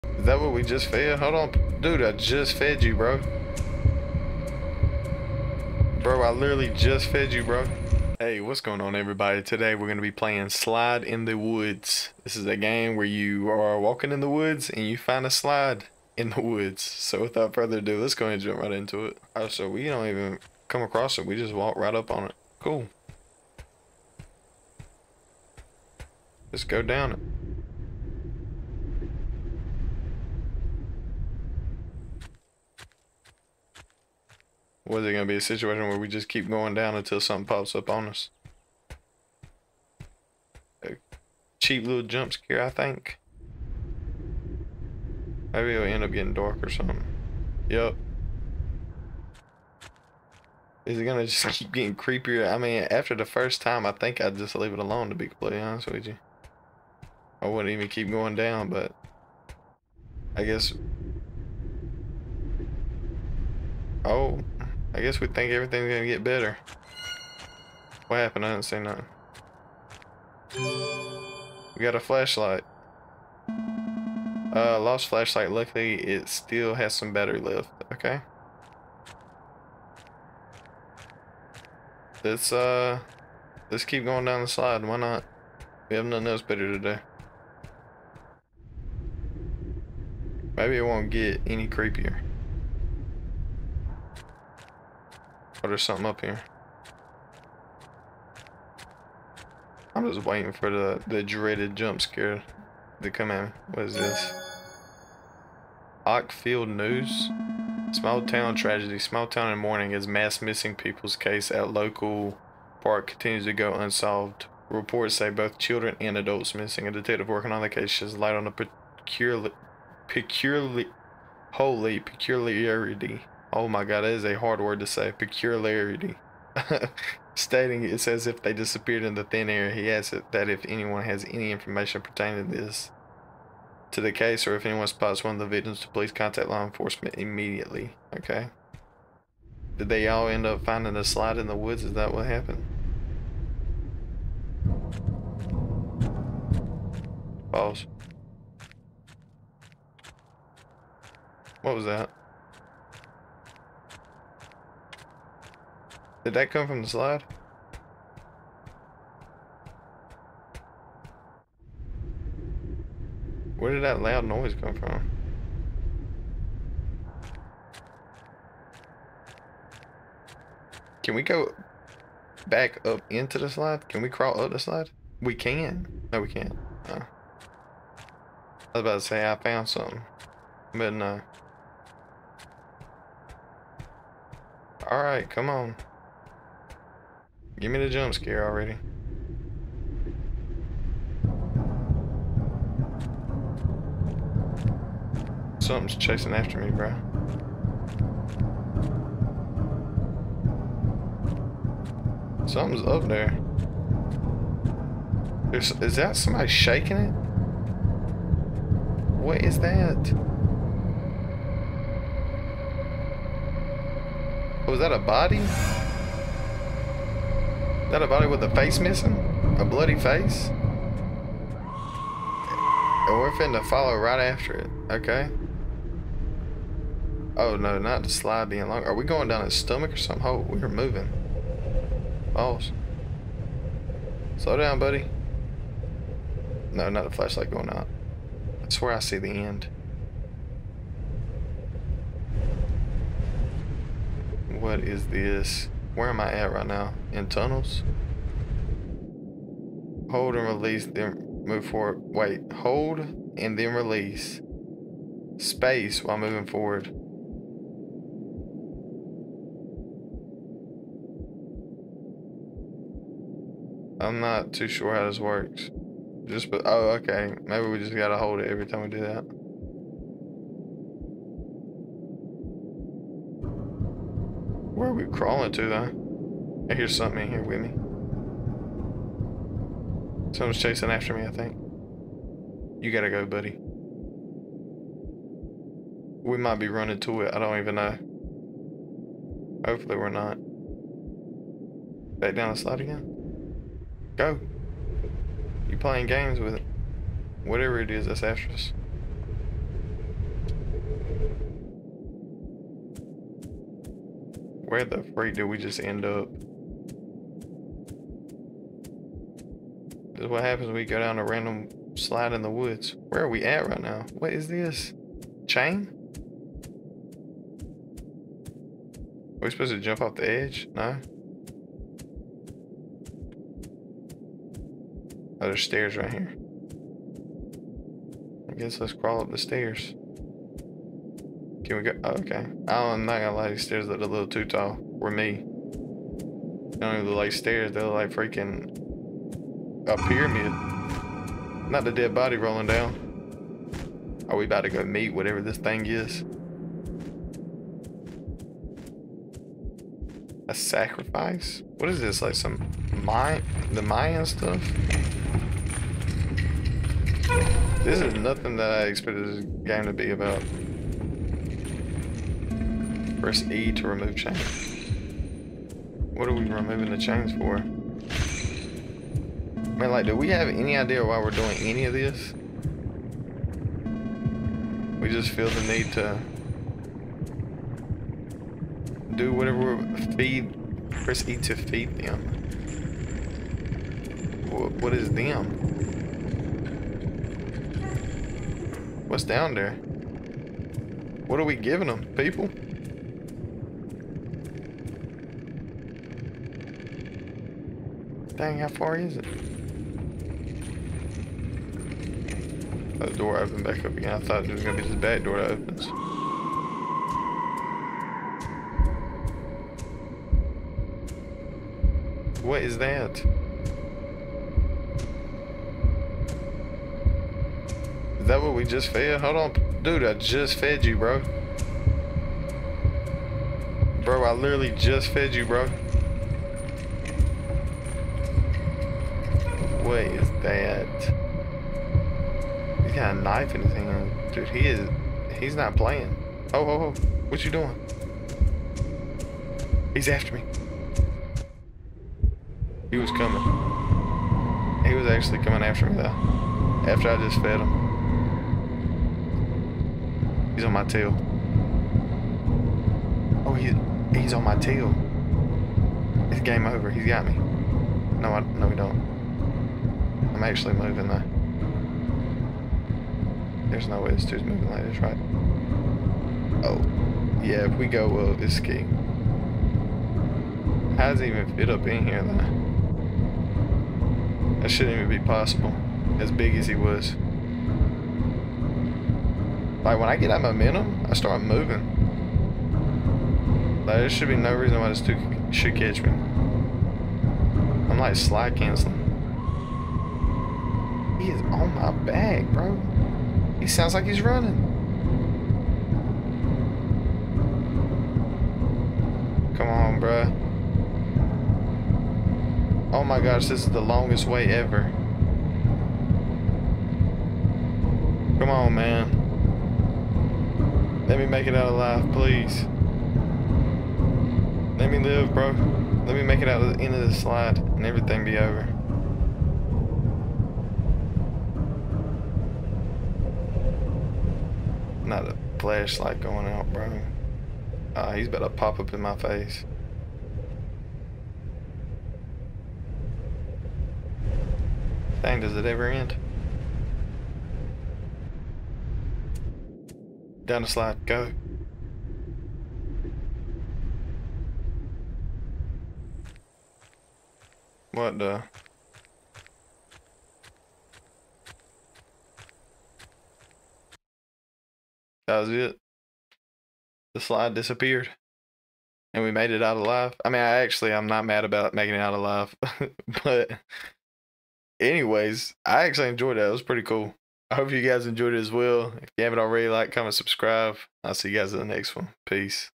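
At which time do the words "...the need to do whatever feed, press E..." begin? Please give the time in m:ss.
6:15.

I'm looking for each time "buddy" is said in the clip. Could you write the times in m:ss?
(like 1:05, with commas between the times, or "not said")
3:54, 4:43.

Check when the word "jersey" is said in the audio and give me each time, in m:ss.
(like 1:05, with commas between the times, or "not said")
not said.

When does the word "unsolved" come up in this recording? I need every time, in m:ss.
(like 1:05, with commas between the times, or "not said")
1:53.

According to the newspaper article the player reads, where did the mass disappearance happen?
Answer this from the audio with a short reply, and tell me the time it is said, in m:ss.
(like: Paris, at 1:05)
Local park, at 1:51.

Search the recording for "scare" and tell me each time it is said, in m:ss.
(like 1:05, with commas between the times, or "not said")
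0:42, 1:42, 3:08.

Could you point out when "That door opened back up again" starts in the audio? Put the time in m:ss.
6:42.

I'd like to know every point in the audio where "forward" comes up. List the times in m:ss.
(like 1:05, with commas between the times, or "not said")
4:11, 4:16.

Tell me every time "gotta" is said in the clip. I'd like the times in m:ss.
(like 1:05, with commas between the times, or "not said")
4:27, 4:42.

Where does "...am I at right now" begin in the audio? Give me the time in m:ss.
4:06.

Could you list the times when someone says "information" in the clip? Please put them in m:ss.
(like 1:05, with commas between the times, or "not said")
2:11.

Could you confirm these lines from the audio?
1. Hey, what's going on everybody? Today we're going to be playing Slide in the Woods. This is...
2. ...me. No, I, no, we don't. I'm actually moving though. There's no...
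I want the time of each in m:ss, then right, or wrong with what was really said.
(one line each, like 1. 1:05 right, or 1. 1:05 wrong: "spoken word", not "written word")
1. 0:08 right
2. 7:37 right.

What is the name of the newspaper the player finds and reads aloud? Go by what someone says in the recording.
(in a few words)
Ockfield News.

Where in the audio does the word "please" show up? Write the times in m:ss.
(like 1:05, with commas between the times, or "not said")
2:15, 8:32.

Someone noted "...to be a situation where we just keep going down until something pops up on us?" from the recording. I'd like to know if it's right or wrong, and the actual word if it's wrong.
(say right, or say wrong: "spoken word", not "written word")
right.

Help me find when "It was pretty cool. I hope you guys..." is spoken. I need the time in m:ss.
9:26.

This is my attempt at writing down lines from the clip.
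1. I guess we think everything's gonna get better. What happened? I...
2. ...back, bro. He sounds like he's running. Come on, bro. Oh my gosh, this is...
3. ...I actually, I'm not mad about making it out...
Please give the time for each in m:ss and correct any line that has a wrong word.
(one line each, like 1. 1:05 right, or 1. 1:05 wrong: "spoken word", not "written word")
1. 1:04 right
2. 8:11 right
3. 9:20 right.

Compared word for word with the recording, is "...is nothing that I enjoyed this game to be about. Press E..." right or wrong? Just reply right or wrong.
wrong.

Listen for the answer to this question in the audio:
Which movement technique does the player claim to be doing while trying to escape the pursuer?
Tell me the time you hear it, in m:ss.
8:08.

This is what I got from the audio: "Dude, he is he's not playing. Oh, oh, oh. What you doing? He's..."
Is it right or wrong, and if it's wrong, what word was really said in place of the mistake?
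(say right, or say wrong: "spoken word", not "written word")
right.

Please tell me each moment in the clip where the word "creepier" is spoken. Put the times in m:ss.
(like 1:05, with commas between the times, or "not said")
0:51, 1:31.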